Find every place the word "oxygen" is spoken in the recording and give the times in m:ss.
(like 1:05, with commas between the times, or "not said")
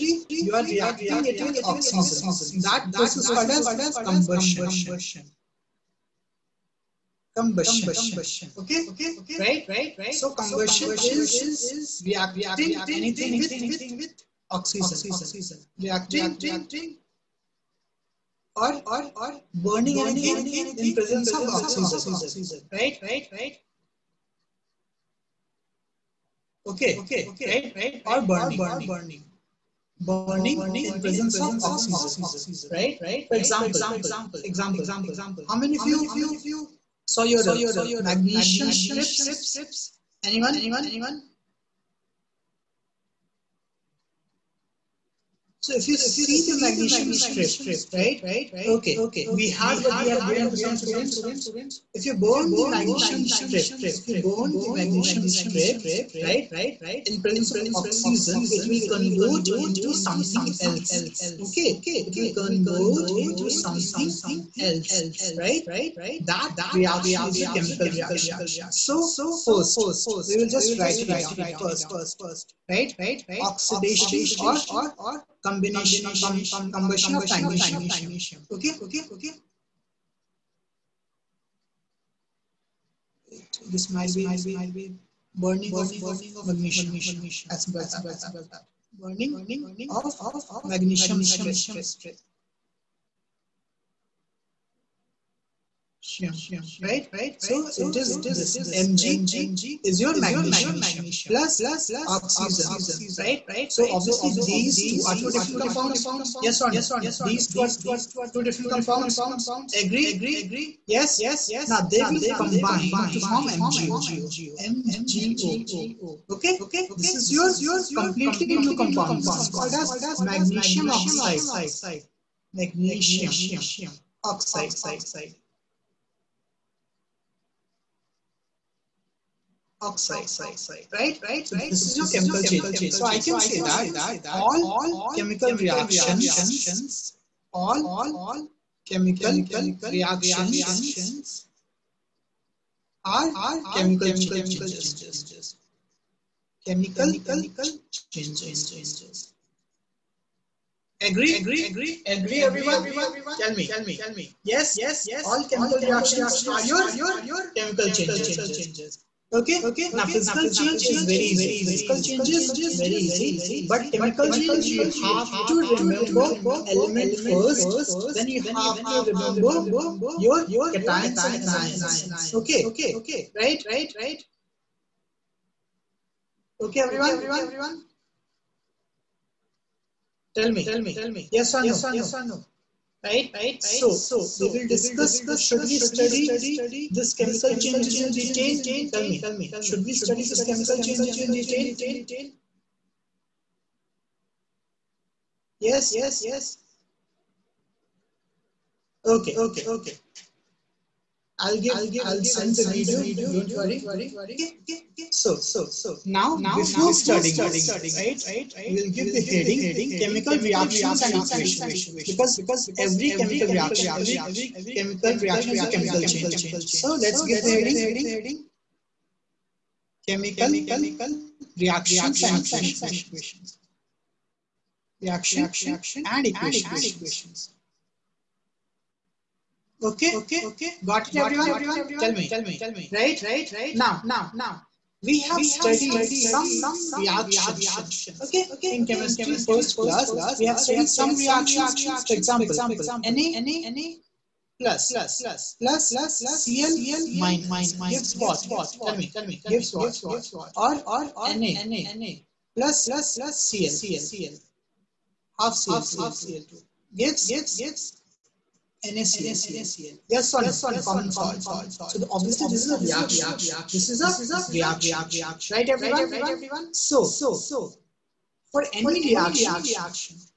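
0:01, 0:14, 0:21, 0:31, 0:57, 1:42.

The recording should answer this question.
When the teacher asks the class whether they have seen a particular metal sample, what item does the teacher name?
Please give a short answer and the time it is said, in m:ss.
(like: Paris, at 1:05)
Magnesium strips, at 0:37.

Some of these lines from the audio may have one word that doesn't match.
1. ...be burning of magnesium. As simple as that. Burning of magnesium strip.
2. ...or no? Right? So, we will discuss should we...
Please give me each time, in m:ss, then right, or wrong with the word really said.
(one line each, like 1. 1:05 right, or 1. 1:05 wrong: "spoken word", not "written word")
1. 1:24 right
2. 3:01 right.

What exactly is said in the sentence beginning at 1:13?
Oxidation or combination, com combustion of magnesium, okay?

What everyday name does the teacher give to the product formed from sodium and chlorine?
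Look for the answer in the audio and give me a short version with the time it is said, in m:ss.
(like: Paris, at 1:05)
Common salt, at 4:20.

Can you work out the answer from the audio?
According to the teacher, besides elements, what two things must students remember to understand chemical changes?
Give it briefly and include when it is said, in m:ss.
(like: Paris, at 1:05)
Cations and anions, at 2:50.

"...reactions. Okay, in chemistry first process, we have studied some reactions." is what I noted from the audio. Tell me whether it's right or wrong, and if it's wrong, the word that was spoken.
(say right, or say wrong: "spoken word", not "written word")
wrong: "class", not "process".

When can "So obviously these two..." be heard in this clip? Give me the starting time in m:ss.
1:43.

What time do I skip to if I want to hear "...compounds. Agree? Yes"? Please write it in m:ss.
1:48.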